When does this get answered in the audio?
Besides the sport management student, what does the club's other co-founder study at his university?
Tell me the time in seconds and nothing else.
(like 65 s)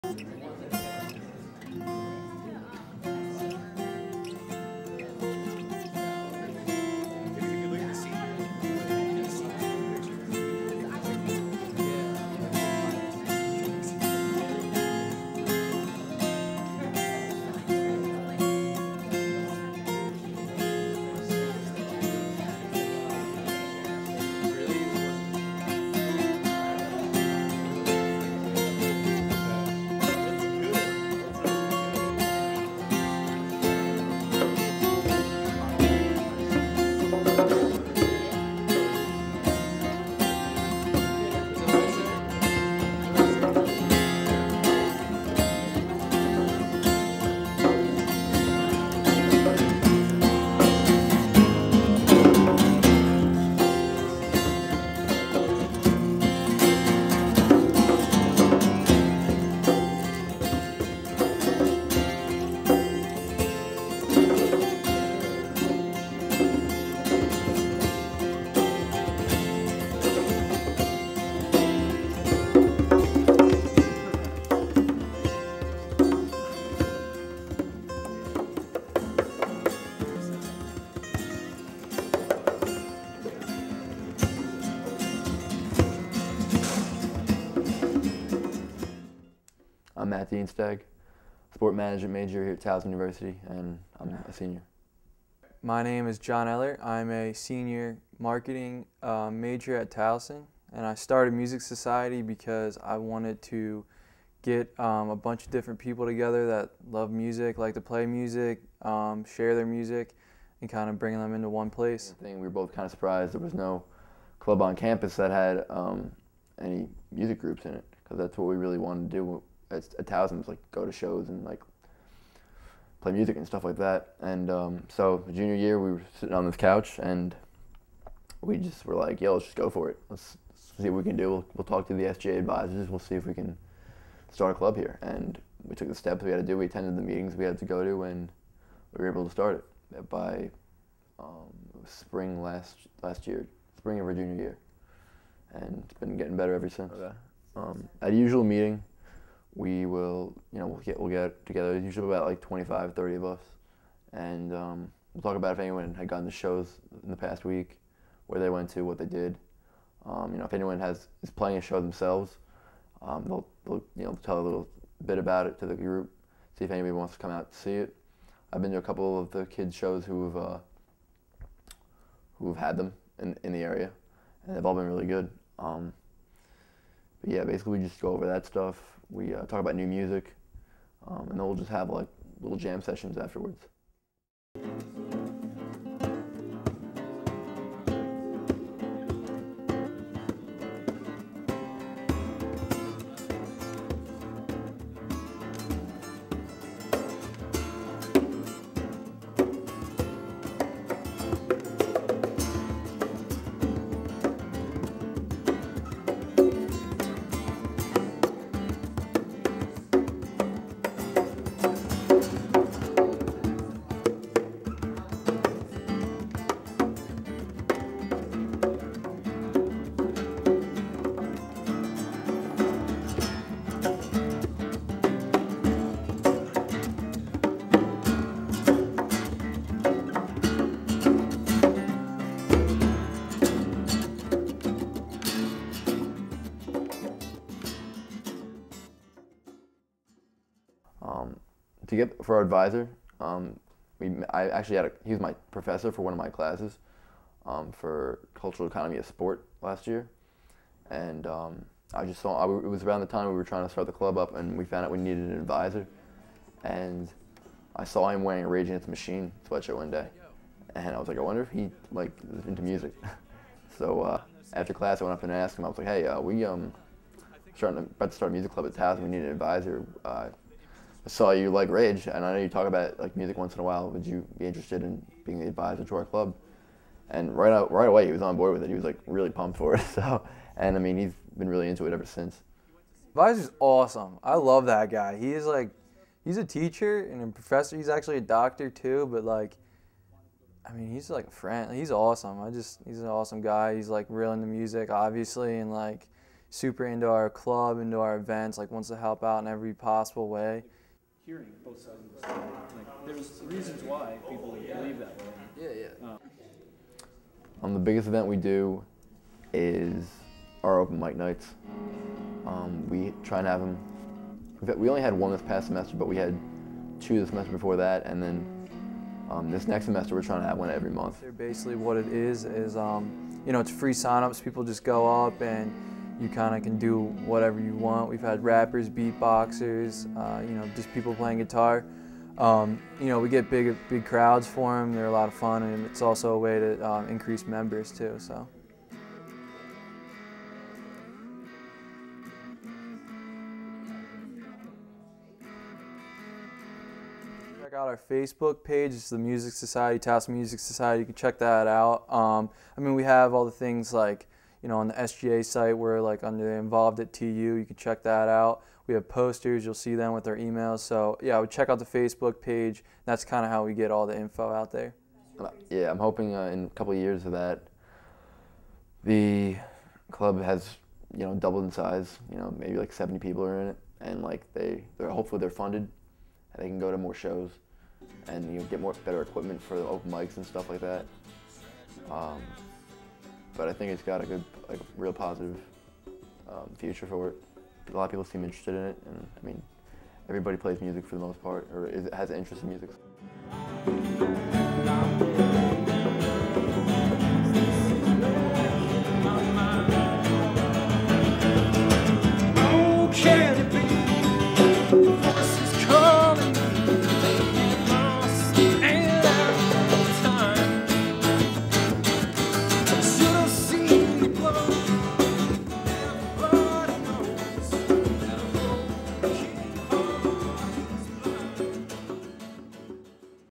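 98 s.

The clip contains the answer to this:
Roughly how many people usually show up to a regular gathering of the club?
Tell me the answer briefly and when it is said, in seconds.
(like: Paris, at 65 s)
25 to 30, at 152 s.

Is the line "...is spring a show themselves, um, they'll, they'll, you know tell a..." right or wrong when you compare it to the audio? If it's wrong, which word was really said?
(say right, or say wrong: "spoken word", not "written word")
wrong: "playing", not "spring".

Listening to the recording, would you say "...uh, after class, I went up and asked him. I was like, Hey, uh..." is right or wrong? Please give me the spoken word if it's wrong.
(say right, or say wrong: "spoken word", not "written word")
right.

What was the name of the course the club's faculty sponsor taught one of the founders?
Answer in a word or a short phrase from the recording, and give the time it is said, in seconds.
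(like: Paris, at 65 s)
cultural economy of sport, at 248 s.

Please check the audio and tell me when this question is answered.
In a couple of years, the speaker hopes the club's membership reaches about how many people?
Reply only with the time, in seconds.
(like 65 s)
372 s.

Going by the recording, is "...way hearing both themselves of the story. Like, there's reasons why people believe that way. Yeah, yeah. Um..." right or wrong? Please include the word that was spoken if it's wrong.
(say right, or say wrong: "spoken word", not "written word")
wrong: "sides", not "themselves".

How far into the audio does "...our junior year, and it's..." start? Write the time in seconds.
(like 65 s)
144 s.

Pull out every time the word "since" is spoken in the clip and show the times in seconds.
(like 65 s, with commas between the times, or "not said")
146 s, 282 s.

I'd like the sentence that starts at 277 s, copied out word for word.
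And right out, right away, he was on board with it.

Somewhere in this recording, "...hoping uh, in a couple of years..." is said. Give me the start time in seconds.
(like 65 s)
365 s.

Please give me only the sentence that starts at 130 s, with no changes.
Let's, let's see what we can do.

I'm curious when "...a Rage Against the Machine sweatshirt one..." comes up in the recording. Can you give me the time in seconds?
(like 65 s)
258 s.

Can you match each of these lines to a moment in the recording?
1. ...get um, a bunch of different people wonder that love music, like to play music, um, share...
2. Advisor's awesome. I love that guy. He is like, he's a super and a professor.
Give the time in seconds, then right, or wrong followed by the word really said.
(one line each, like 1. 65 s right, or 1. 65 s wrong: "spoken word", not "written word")
1. 104 s wrong: "together", not "wonder"
2. 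283 s wrong: "teacher", not "super".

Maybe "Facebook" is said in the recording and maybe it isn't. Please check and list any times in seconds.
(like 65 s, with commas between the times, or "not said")
348 s, 361 s.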